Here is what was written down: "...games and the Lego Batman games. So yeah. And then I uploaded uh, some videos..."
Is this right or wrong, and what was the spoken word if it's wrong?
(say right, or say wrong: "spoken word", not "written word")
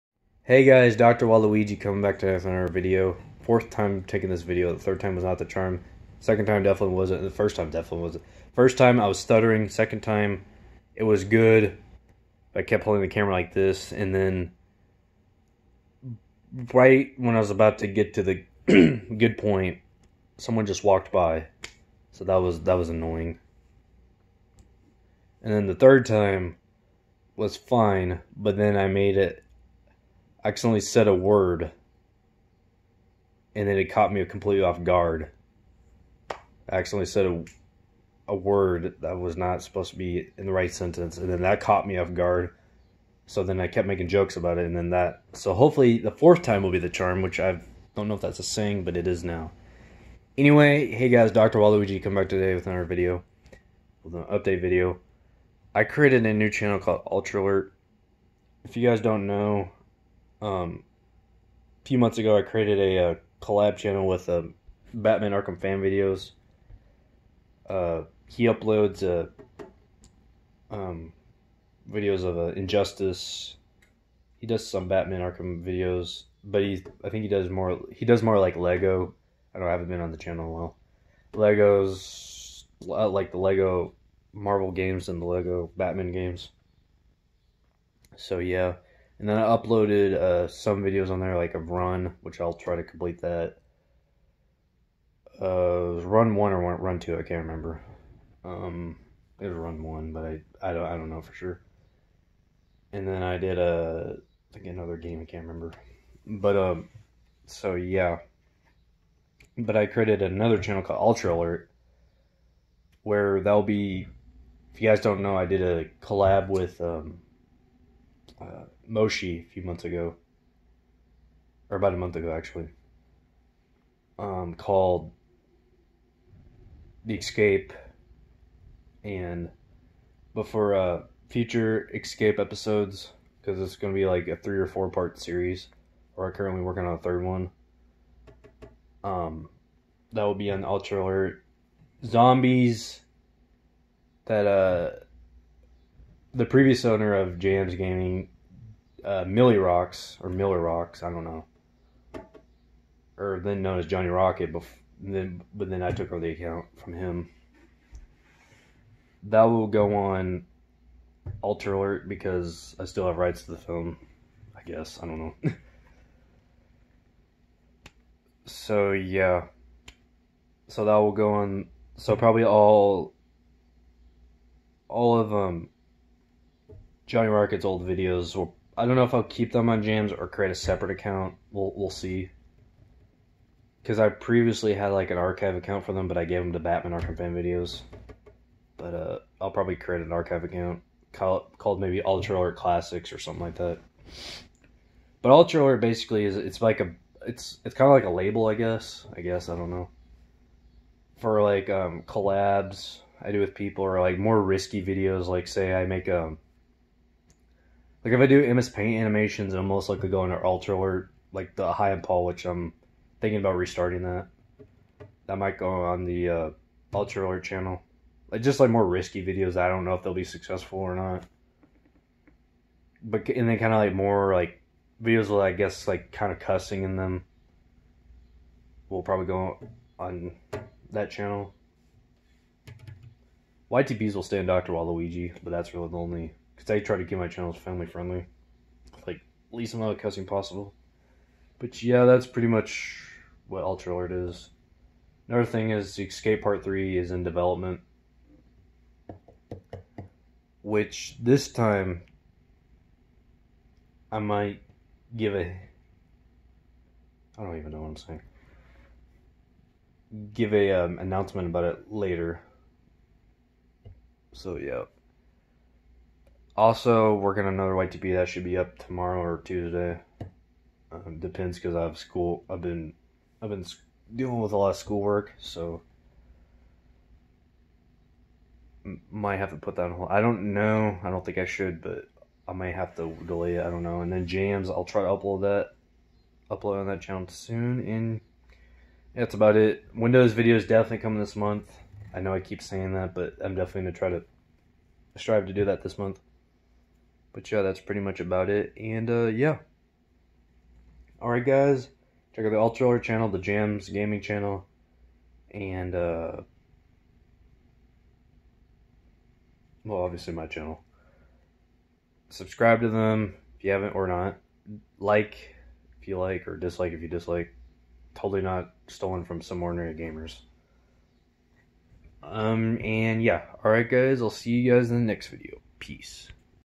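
right.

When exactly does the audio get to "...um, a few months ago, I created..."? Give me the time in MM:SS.
01:00.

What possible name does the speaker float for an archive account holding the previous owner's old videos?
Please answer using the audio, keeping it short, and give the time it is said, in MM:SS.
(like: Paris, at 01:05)
Ultra Alert Classics, at 03:12.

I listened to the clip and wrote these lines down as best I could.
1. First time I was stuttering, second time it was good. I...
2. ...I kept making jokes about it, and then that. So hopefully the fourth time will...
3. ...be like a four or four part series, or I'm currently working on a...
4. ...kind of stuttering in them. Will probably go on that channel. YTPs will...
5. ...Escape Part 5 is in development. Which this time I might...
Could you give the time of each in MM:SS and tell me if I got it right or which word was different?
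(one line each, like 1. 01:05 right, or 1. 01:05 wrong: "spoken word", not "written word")
1. 00:08 right
2. 00:43 right
3. 02:13 wrong: "three", not "four"
4. 03:46 wrong: "cussing", not "stuttering"
5. 04:06 wrong: "3", not "5".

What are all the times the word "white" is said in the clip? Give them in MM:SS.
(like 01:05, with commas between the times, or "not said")
04:27.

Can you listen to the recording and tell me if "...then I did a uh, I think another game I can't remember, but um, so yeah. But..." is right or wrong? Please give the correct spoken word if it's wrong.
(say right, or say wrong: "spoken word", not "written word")
right.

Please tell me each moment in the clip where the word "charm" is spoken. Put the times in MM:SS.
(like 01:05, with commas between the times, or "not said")
00:05, 00:46.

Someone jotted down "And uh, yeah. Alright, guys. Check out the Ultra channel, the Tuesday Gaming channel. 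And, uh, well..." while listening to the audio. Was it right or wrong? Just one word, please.
wrong.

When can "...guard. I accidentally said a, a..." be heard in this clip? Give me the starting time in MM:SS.
00:34.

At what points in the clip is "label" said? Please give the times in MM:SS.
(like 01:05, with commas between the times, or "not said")
03:18.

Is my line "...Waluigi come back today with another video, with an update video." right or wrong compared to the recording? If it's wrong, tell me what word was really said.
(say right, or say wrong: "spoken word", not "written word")
right.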